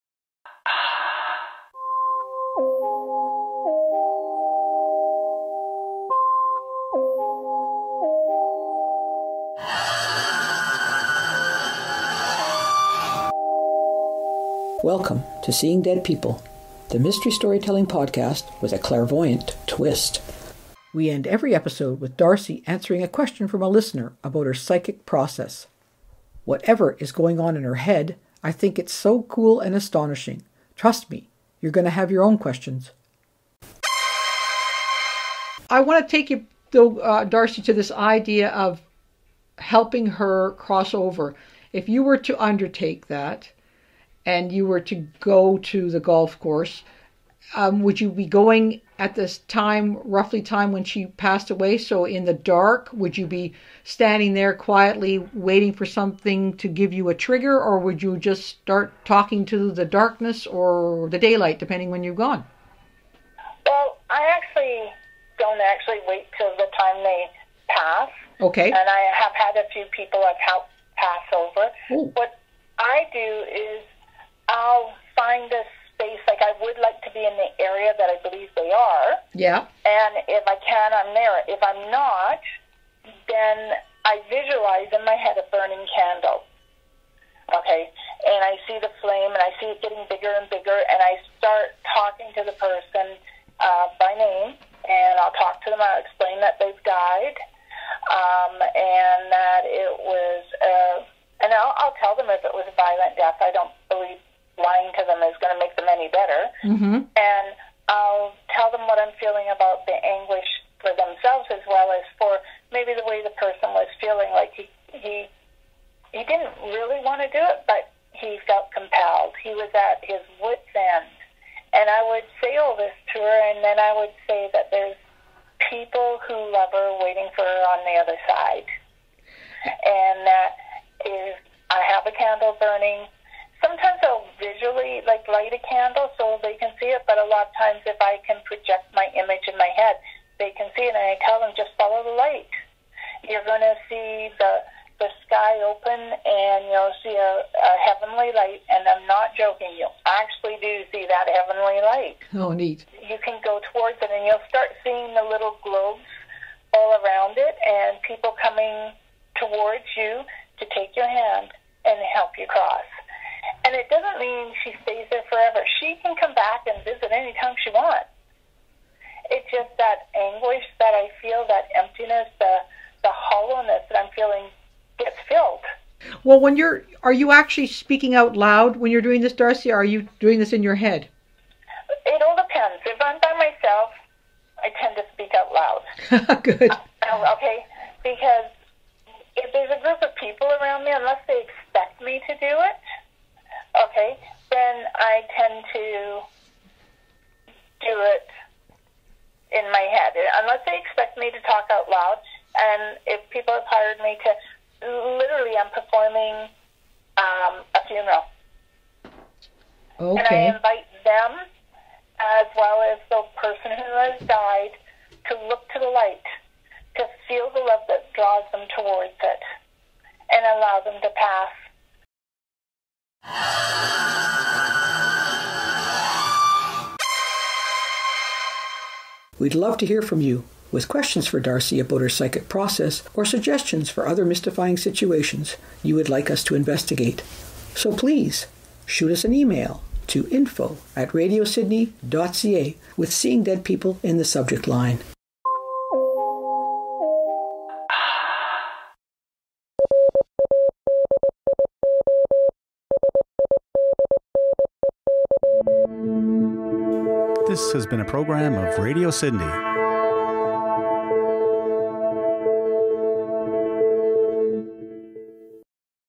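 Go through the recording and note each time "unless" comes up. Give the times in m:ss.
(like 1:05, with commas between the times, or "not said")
3:10, 3:20.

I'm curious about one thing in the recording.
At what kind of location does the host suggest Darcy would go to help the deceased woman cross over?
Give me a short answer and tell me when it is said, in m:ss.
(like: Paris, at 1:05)
Golf course, at 0:45.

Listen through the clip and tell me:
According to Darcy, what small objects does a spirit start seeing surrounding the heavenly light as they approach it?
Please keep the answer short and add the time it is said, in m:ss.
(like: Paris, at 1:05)
Little globes, at 2:35.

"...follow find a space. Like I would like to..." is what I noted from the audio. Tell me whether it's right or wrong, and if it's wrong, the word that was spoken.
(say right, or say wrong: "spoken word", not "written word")
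wrong: "somehow", not "follow".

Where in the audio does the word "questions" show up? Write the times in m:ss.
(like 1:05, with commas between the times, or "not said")
0:23, 0:32, 3:50.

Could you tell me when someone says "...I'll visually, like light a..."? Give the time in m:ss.
2:14.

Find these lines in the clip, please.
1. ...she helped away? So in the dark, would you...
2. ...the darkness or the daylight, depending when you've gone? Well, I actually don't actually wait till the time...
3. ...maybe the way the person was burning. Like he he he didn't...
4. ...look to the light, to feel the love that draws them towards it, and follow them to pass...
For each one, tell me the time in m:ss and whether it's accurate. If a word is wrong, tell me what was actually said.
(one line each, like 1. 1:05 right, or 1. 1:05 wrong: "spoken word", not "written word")
1. 0:50 wrong: "passed", not "helped"
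2. 0:59 right
3. 1:52 wrong: "feeling", not "burning"
4. 3:35 wrong: "allow", not "follow".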